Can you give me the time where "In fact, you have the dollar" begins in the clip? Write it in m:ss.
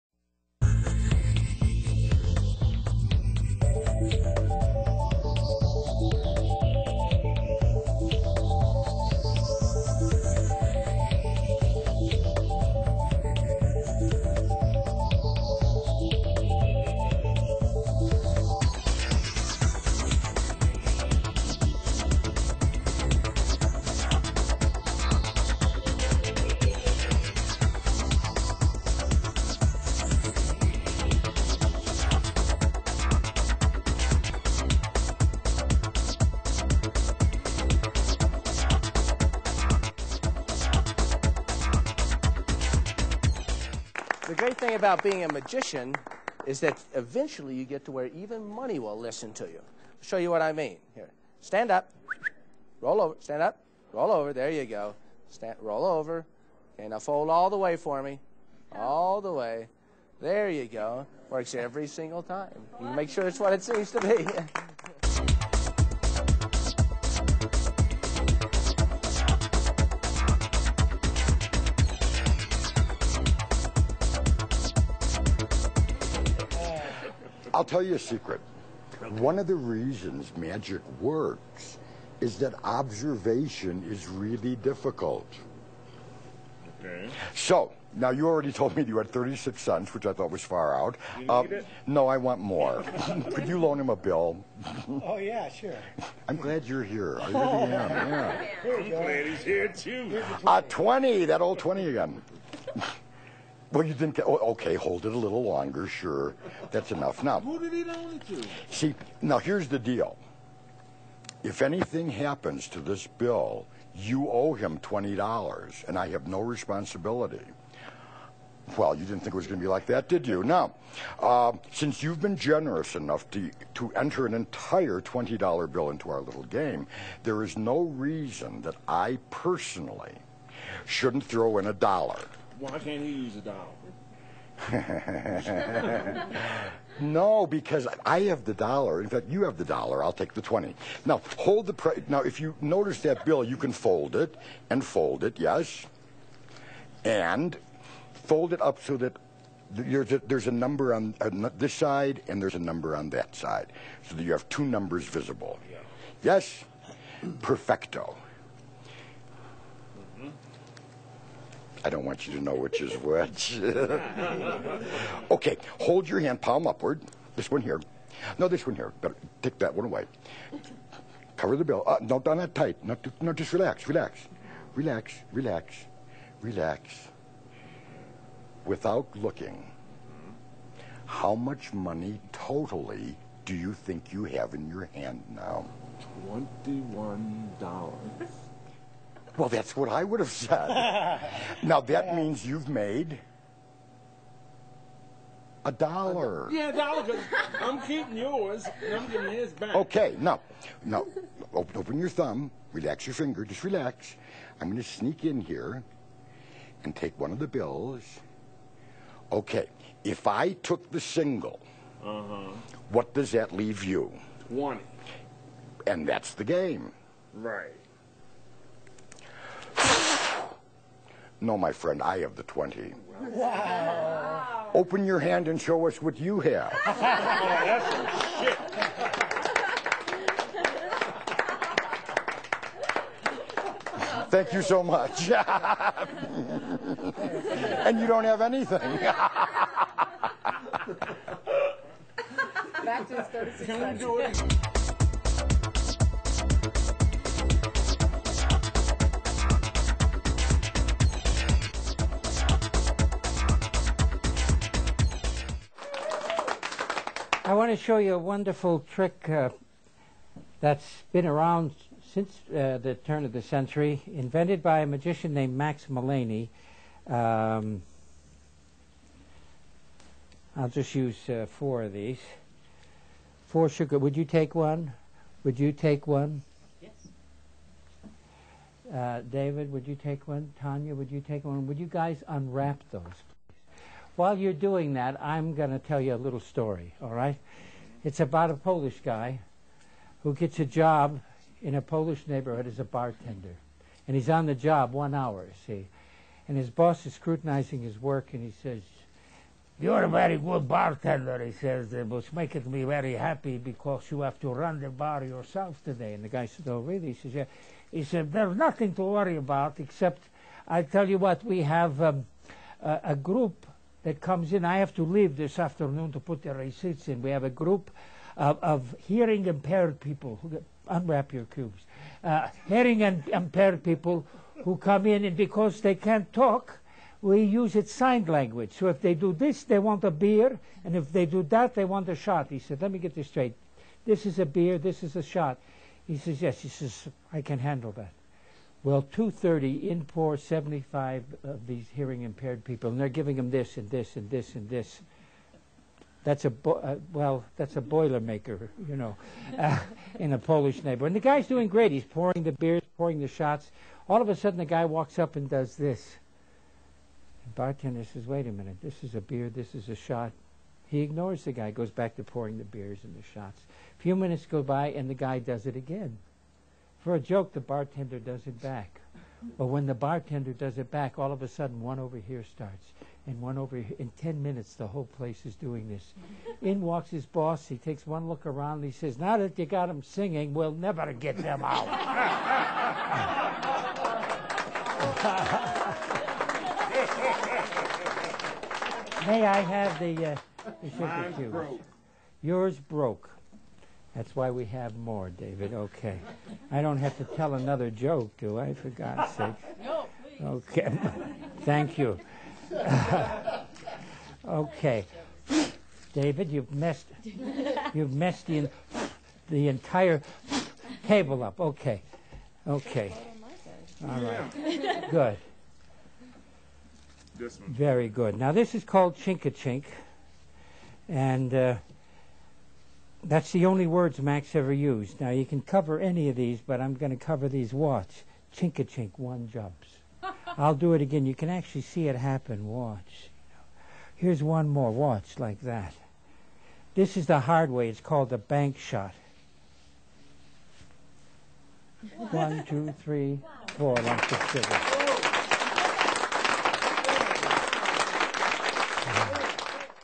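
2:19.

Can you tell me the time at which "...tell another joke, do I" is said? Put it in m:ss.
6:37.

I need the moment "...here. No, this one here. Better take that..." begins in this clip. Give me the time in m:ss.
2:47.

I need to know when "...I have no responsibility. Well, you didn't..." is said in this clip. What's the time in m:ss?
1:55.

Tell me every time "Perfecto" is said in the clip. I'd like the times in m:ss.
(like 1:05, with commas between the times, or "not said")
2:37.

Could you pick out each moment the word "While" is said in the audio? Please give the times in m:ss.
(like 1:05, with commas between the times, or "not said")
4:44.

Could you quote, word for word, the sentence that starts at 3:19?
Okay, now, now, open, open your thumb, relax your finger, just relax.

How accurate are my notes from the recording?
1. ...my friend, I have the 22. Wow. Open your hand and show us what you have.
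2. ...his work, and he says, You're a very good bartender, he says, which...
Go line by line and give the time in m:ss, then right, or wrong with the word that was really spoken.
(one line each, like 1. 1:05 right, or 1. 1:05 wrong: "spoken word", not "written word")
1. 3:41 wrong: "20", not "22"
2. 4:57 right.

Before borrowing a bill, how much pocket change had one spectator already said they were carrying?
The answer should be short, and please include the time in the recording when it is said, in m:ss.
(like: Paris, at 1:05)
36 cents, at 1:29.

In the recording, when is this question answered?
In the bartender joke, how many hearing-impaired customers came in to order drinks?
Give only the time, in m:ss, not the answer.
5:40.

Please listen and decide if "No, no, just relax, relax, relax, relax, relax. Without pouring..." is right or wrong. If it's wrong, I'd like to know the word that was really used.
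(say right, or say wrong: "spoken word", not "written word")
wrong: "looking", not "pouring".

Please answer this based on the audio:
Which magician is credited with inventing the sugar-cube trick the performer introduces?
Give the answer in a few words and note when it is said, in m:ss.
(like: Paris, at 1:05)
Max Malini, at 4:25.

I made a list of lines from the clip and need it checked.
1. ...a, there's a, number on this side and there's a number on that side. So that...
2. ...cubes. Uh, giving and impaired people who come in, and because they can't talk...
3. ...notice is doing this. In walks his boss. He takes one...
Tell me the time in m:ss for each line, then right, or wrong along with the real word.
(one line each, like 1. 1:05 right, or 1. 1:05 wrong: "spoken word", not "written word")
1. 2:30 right
2. 5:21 wrong: "hearing", not "giving"
3. 6:15 wrong: "place", not "notice".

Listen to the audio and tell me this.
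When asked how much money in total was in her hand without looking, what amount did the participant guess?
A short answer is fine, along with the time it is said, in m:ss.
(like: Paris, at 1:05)
$21, at 3:06.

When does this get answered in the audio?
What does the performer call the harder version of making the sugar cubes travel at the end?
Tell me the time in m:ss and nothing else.
7:18.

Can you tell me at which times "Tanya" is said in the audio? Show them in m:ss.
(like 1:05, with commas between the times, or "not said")
4:40.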